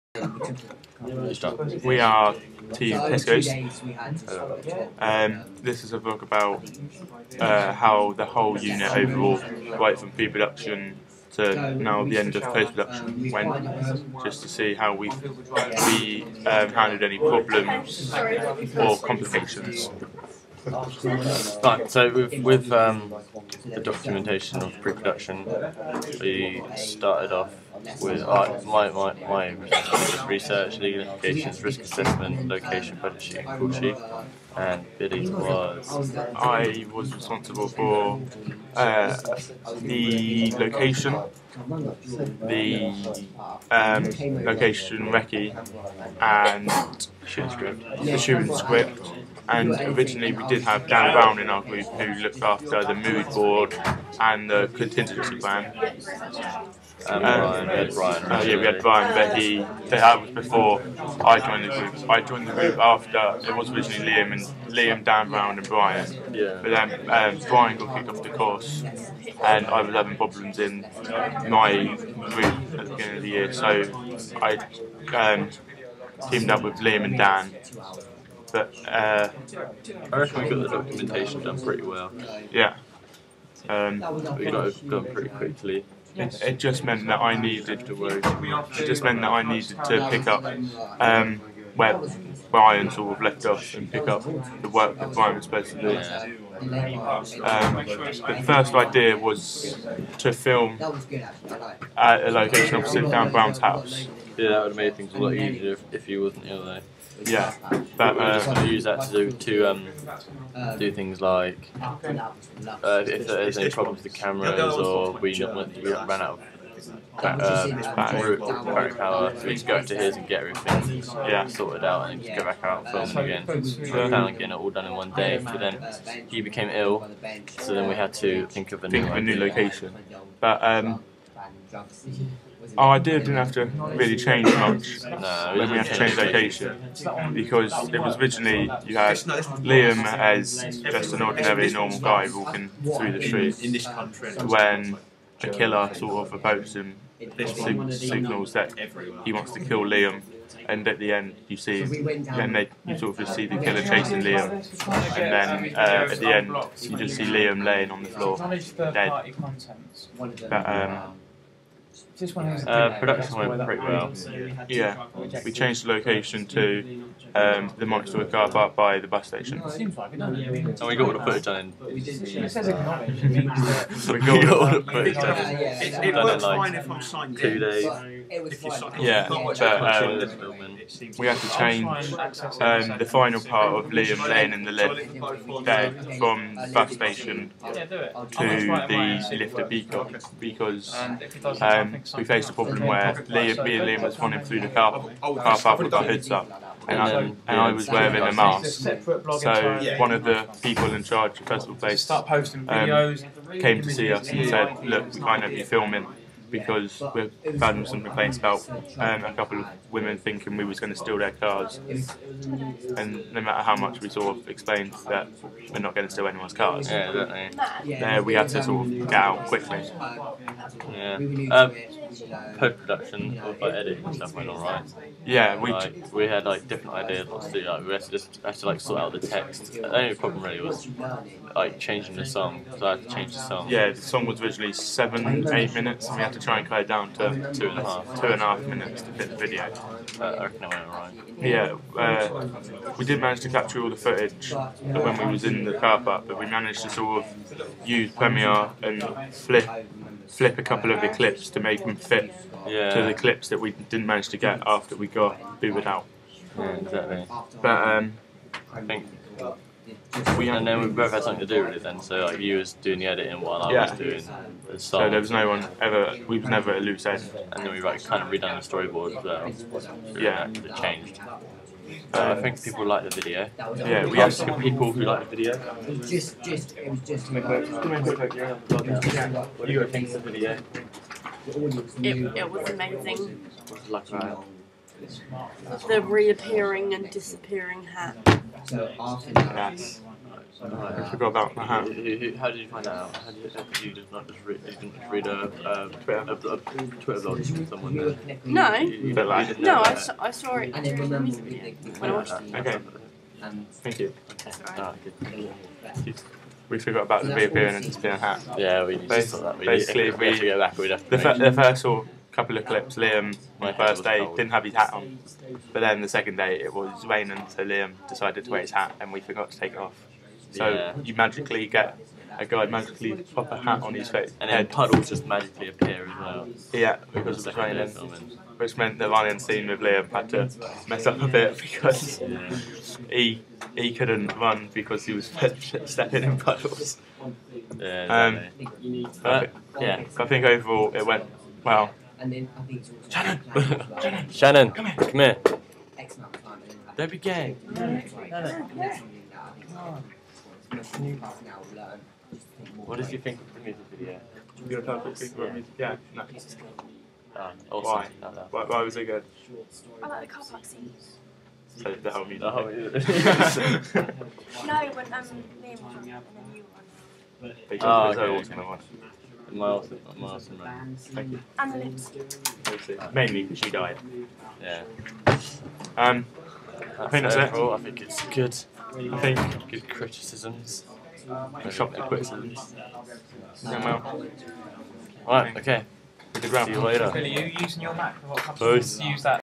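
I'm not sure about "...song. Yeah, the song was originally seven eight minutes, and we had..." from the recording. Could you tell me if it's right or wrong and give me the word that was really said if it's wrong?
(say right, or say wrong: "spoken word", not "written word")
right.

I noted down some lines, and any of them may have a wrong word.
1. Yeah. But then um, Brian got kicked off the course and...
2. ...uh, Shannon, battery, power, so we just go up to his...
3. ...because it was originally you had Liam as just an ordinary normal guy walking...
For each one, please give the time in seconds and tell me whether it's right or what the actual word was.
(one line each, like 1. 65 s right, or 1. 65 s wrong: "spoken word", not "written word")
1. 66 s right
2. 116 s wrong: "Back", not "Shannon"
3. 137 s right.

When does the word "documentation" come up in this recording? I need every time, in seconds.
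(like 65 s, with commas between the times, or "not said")
23 s, 80 s.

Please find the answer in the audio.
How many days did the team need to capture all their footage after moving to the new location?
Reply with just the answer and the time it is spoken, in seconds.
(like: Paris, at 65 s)
2, at 177 s.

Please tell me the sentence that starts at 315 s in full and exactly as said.
But then the second day, it was raining, so Liam decided to wear his hat and we forgot to take it off.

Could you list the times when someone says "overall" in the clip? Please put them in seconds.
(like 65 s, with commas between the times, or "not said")
8 s, 340 s.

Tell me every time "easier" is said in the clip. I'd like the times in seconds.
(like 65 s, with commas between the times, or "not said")
105 s.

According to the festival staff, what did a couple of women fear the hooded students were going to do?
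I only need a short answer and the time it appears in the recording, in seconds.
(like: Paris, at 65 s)
steal their cars, at 210 s.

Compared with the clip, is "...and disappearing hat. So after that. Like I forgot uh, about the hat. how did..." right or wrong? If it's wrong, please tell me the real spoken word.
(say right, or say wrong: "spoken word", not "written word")
right.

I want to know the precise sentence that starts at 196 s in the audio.
And I, and I was wearing a mask.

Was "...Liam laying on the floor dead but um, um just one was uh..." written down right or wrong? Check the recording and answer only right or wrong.
right.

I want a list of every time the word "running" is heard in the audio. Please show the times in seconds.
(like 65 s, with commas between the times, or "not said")
194 s, 329 s.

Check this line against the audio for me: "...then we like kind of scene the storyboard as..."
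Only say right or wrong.
wrong.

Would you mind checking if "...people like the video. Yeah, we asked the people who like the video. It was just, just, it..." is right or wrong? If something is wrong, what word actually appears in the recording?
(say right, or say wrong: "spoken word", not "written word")
right.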